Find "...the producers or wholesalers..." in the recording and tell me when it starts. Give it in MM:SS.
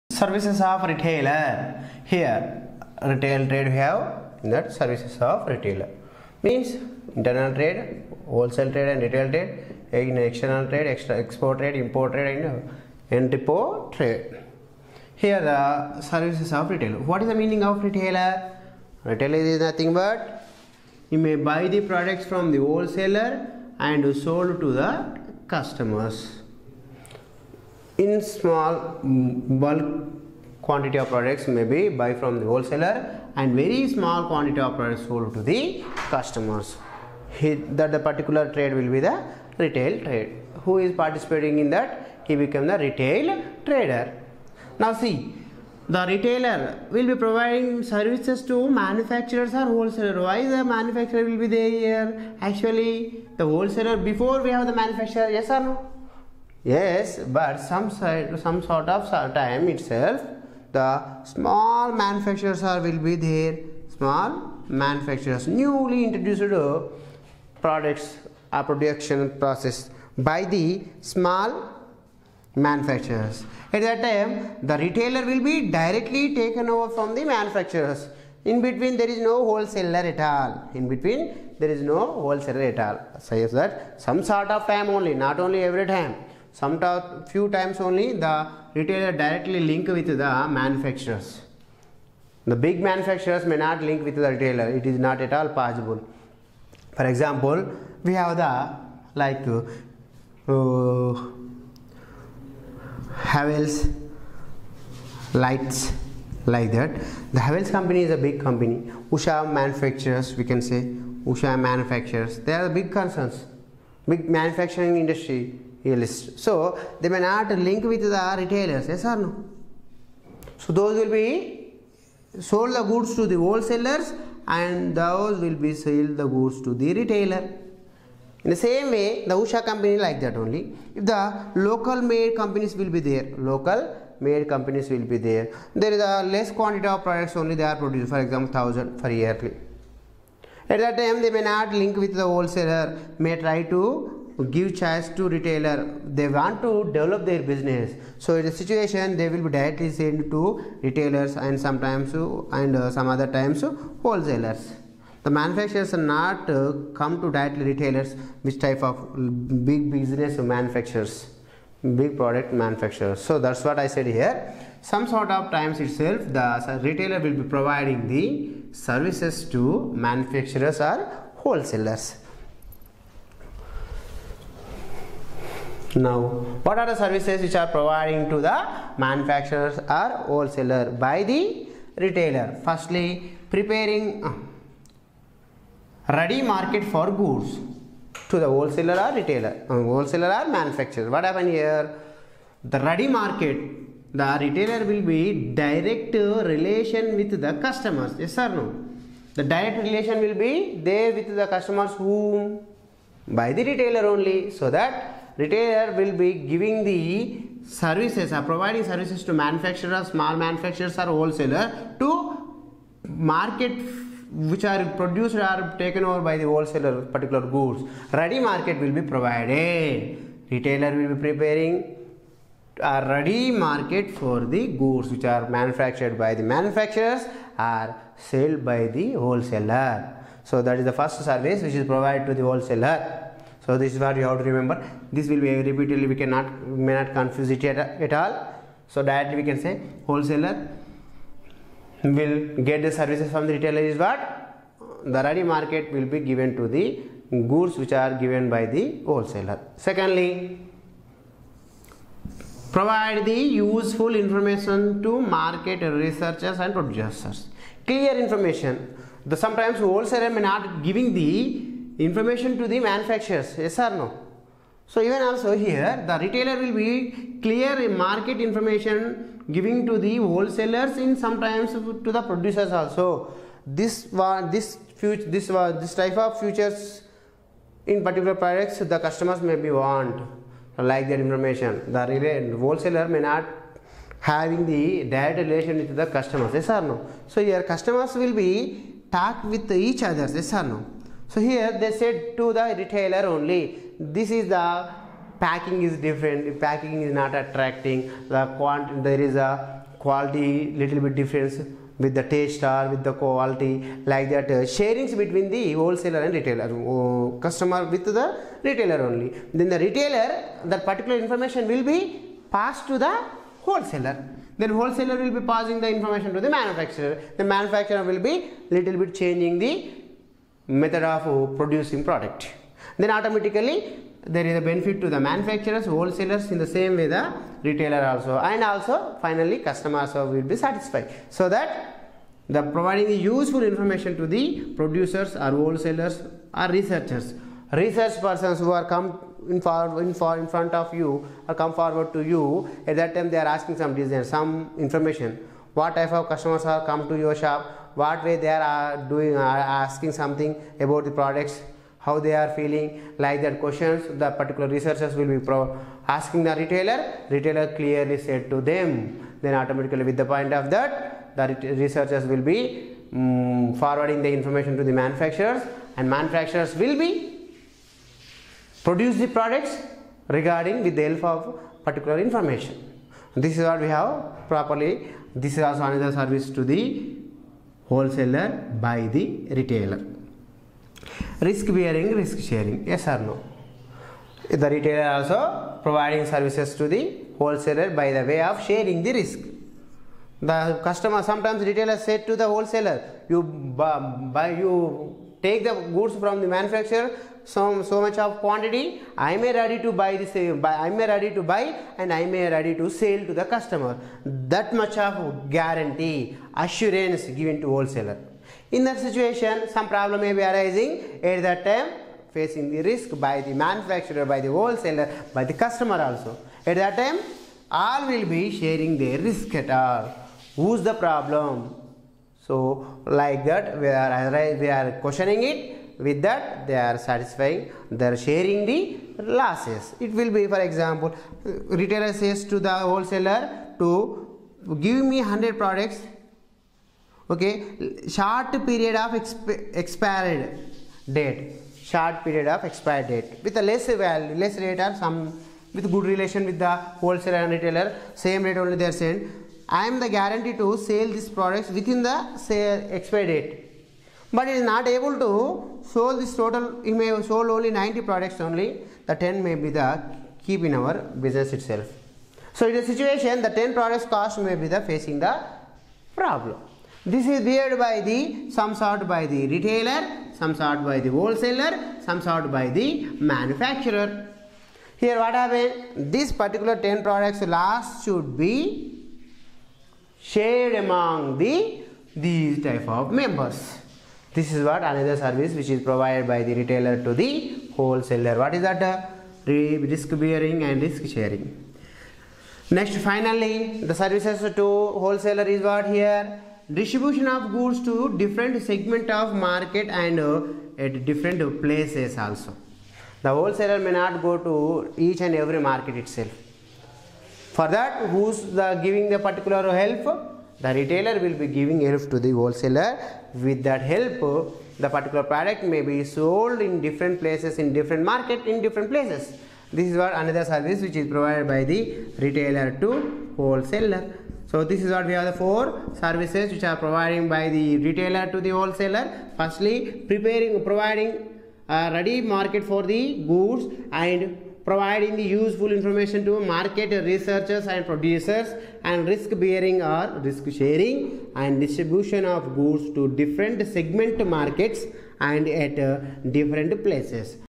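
05:34.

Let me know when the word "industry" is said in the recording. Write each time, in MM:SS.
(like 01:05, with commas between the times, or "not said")
01:54.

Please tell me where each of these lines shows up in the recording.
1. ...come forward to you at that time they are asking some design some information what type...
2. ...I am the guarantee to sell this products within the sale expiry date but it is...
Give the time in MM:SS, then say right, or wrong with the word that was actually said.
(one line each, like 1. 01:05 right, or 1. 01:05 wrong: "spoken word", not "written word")
1. 05:41 right
2. 07:29 right.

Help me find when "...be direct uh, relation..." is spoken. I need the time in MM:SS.
03:15.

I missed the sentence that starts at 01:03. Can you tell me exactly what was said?
Small manufacturers, newly introduced uh, products, are uh, production process by the small manufacturers.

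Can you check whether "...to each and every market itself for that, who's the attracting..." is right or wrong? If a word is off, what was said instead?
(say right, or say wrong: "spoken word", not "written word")
wrong: "giving", not "attracting".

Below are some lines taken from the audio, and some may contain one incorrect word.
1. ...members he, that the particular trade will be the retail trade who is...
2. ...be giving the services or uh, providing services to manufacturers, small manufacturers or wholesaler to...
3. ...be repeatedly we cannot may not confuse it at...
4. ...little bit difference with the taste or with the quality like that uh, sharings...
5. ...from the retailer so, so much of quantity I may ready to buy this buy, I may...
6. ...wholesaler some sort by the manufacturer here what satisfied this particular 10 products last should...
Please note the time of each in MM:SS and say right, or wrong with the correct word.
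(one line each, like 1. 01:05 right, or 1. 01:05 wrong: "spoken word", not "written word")
1. 00:36 wrong: "customers", not "members"
2. 03:26 right
3. 03:55 right
4. 05:00 right
5. 06:36 wrong: "manufacturer", not "retailer"
6. 07:51 wrong: "happened", not "satisfied".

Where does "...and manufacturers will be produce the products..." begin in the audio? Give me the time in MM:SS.
06:05.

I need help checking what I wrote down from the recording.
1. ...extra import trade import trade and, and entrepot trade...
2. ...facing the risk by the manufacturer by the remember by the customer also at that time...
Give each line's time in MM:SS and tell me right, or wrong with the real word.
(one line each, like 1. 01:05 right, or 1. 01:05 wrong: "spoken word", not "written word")
1. 00:10 wrong: "export", not "import"
2. 06:52 wrong: "wholesaler", not "remember".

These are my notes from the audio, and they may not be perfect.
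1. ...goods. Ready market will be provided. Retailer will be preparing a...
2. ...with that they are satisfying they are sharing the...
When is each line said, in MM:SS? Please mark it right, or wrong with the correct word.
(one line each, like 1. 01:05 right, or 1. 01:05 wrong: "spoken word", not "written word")
1. 03:37 right
2. 07:05 right.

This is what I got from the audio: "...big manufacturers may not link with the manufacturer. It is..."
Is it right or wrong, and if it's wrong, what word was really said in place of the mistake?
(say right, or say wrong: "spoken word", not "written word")
wrong: "retailer", not "manufacturer".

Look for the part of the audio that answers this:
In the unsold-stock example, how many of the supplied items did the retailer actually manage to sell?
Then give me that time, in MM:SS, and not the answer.
07:37.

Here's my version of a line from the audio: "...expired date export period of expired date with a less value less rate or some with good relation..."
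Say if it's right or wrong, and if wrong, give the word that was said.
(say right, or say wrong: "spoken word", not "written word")
wrong: "short", not "export".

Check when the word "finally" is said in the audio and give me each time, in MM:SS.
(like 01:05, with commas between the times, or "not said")
05:29, 08:13.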